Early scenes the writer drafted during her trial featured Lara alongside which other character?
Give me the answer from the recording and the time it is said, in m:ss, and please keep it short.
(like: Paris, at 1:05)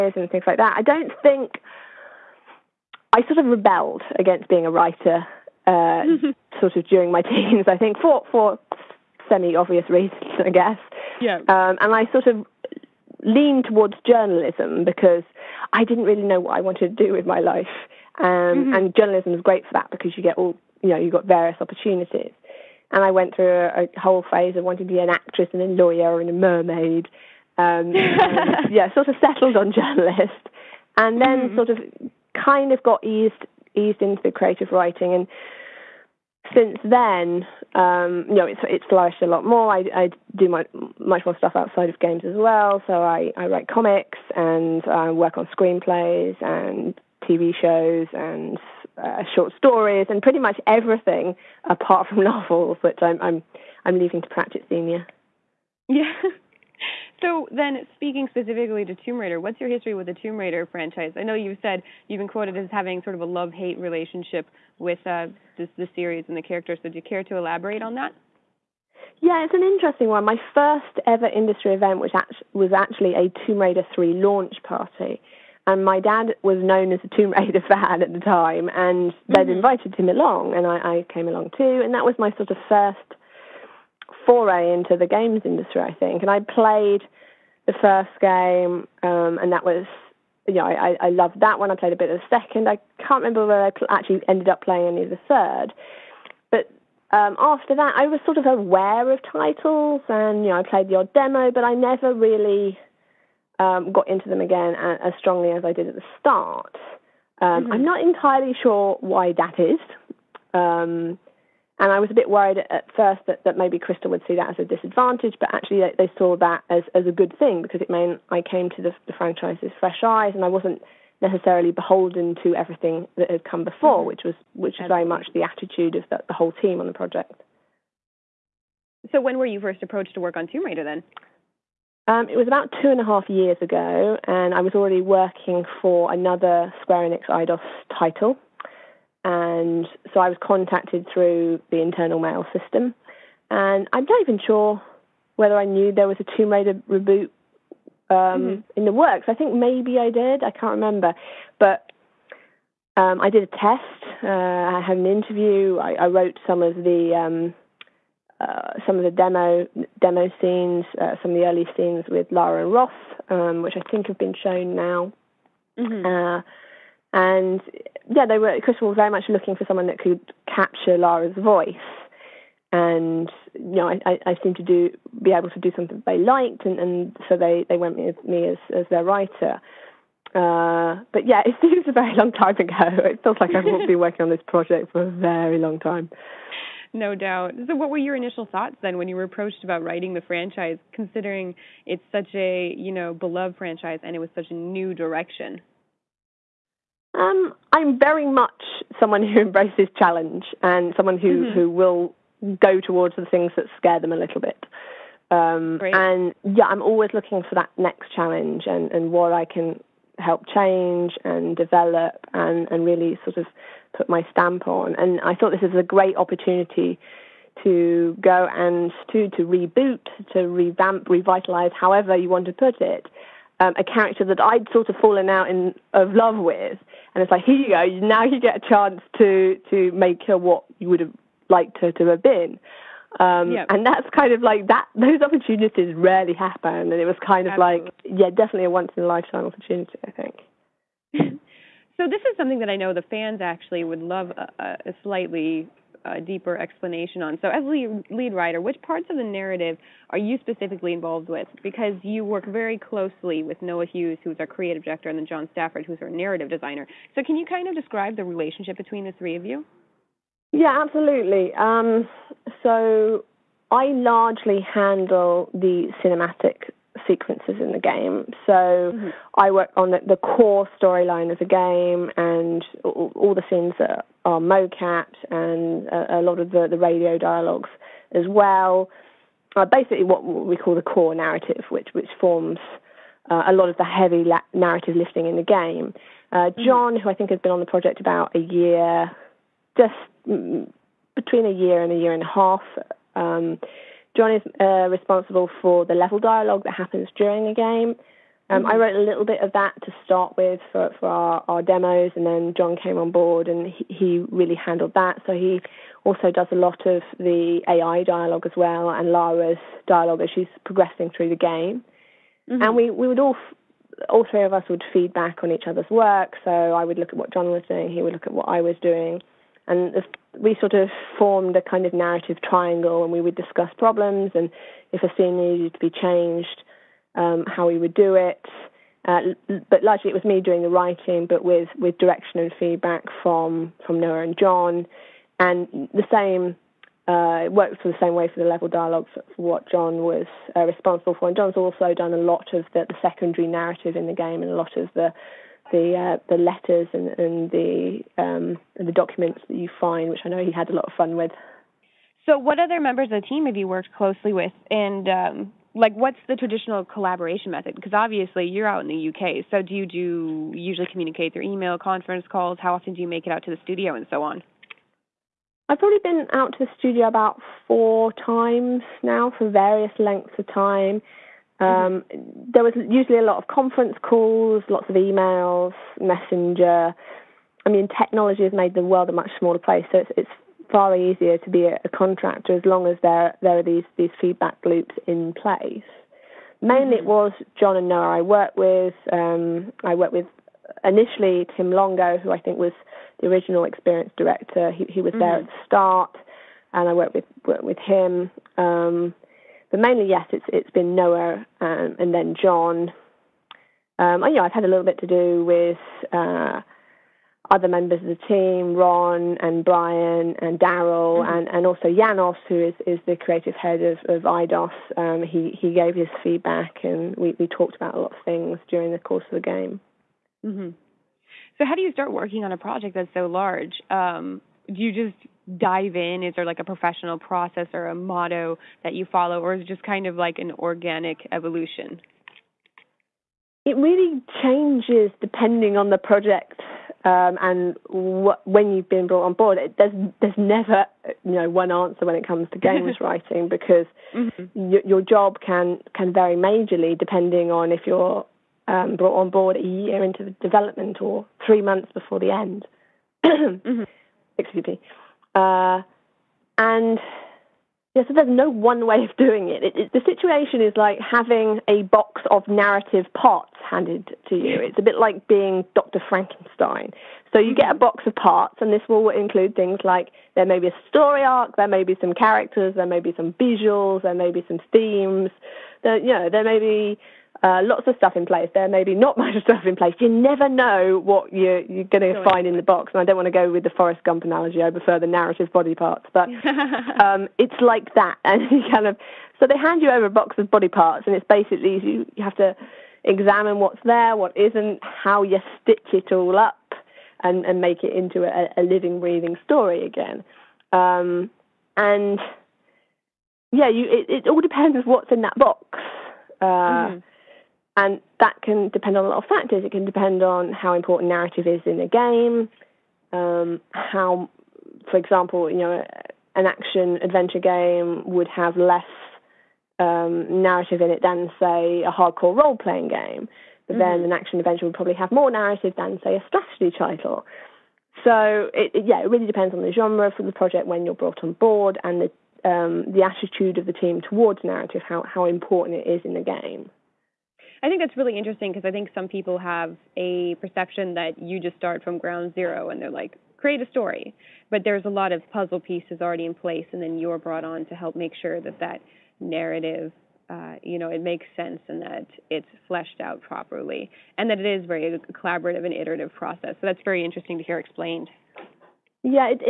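Ross, at 2:42.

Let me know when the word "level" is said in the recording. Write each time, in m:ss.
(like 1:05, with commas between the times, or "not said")
4:55, 5:38.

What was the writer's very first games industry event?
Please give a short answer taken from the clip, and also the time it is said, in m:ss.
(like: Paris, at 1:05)
Tomb Raider 3 launch party, at 1:13.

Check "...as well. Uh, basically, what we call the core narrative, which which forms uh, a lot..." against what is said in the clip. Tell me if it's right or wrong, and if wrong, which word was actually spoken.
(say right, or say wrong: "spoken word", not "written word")
right.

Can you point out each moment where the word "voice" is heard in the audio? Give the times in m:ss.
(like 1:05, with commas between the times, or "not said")
2:51.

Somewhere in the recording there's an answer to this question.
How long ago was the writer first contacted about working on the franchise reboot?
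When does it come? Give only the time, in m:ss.
2:12.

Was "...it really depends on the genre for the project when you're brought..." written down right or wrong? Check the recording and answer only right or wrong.
right.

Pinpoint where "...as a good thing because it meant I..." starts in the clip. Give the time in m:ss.
1:56.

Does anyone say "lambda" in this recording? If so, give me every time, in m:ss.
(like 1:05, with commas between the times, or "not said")
not said.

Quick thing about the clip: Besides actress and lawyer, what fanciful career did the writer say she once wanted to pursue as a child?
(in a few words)
mermaid.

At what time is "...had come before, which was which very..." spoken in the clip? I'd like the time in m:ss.
2:03.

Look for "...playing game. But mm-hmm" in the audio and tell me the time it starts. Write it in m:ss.
8:42.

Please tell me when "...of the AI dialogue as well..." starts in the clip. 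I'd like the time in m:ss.
5:06.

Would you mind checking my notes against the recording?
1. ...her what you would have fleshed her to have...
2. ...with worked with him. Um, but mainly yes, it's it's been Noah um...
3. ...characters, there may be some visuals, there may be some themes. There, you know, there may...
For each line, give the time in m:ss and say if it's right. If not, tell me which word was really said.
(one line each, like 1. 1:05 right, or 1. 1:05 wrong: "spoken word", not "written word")
1. 3:50 wrong: "liked", not "fleshed"
2. 6:37 right
3. 7:52 right.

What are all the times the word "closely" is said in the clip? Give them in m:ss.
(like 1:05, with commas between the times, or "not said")
4:12, 5:53.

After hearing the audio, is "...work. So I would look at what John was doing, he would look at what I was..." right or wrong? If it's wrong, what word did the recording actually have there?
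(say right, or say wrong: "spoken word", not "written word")
right.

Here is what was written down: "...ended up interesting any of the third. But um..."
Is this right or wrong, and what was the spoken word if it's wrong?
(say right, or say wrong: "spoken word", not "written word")
wrong: "playing", not "interesting".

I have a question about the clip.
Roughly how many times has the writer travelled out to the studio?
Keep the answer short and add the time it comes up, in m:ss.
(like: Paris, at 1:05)
4, at 6:07.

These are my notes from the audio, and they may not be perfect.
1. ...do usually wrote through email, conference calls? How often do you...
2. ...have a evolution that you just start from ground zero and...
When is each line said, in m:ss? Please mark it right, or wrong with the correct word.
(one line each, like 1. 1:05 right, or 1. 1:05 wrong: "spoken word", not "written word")
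1. 5:59 wrong: "communicate", not "wrote"
2. 8:59 wrong: "perception", not "evolution".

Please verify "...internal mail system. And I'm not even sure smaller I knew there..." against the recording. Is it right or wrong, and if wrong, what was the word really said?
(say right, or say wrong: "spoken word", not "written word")
wrong: "whether", not "smaller".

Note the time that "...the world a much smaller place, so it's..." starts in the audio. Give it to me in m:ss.
6:18.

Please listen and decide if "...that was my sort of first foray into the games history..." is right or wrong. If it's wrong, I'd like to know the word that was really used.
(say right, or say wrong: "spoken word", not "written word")
wrong: "industry", not "history".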